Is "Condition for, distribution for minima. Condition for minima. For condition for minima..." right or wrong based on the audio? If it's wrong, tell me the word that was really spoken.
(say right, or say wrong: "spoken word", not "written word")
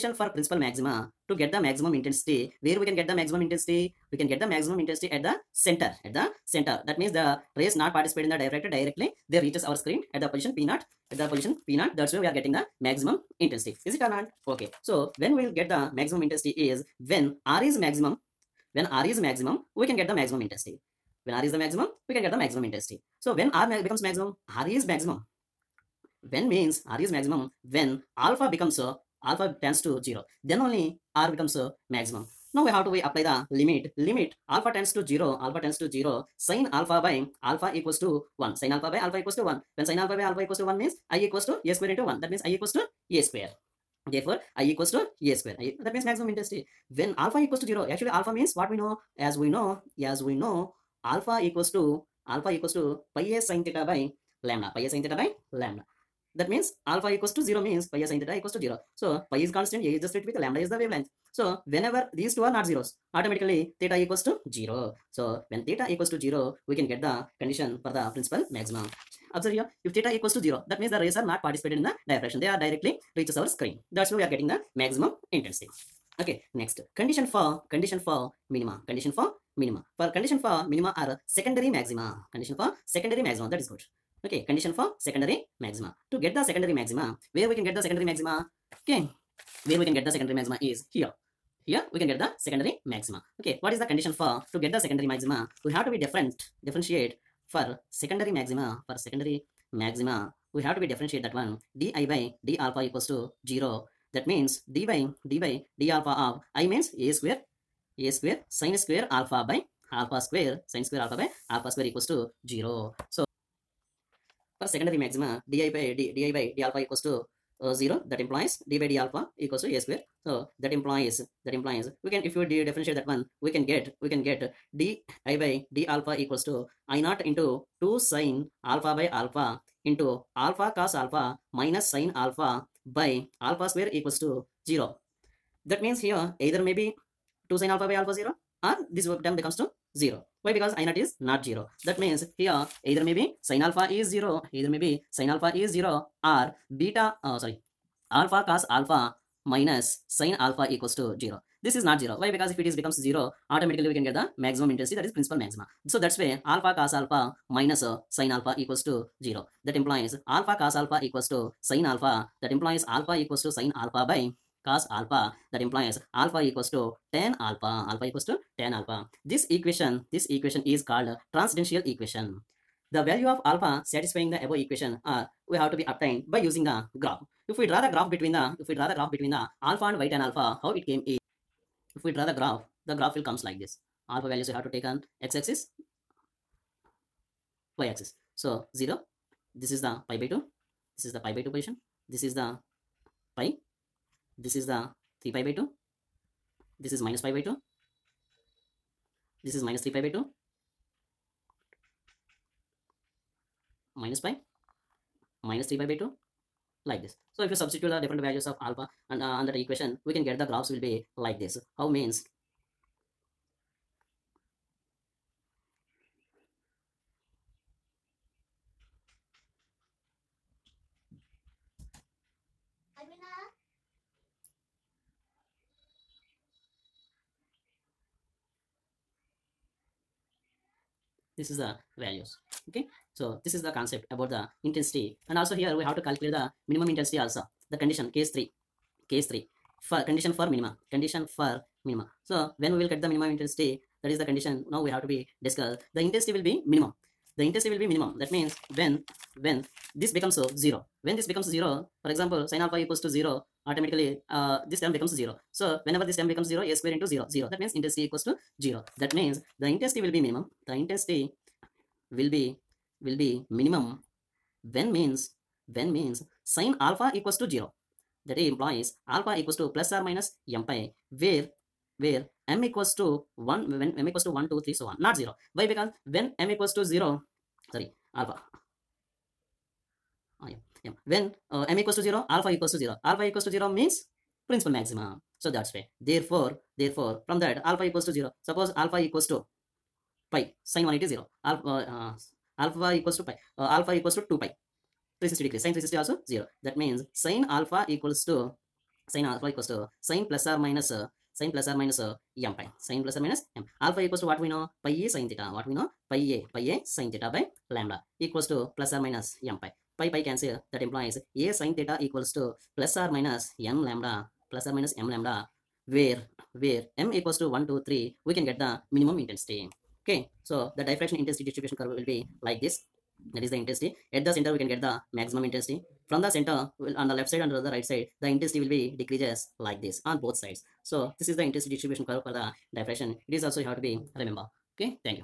wrong: "condition", not "distribution".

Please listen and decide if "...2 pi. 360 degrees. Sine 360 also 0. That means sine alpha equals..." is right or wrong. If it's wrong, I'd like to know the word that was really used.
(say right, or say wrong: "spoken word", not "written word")
right.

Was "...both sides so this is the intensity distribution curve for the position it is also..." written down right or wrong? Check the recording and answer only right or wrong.
wrong.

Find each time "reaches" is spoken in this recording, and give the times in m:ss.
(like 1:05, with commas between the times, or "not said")
0:09, 1:13.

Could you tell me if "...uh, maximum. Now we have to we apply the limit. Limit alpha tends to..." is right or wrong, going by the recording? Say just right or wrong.
right.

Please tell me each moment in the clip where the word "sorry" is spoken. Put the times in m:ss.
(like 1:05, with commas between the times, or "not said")
2:27, 4:37.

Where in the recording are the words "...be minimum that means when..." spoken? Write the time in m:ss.
4:07.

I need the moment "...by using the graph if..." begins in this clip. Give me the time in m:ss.
2:56.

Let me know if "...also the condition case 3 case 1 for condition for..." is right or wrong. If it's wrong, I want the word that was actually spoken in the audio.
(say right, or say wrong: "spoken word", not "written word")
wrong: "3", not "1".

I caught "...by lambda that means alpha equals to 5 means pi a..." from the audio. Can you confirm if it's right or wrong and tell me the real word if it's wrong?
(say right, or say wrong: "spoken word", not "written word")
wrong: "0", not "5".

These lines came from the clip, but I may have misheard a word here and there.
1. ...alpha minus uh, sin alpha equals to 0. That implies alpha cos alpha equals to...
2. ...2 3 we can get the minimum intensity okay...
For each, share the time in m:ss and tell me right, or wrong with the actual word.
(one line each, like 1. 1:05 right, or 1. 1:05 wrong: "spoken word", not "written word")
1. 2:36 right
2. 5:17 right.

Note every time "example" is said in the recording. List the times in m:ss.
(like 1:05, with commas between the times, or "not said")
4:12.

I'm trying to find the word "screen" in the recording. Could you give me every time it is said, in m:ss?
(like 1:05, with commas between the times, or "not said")
0:09, 1:13.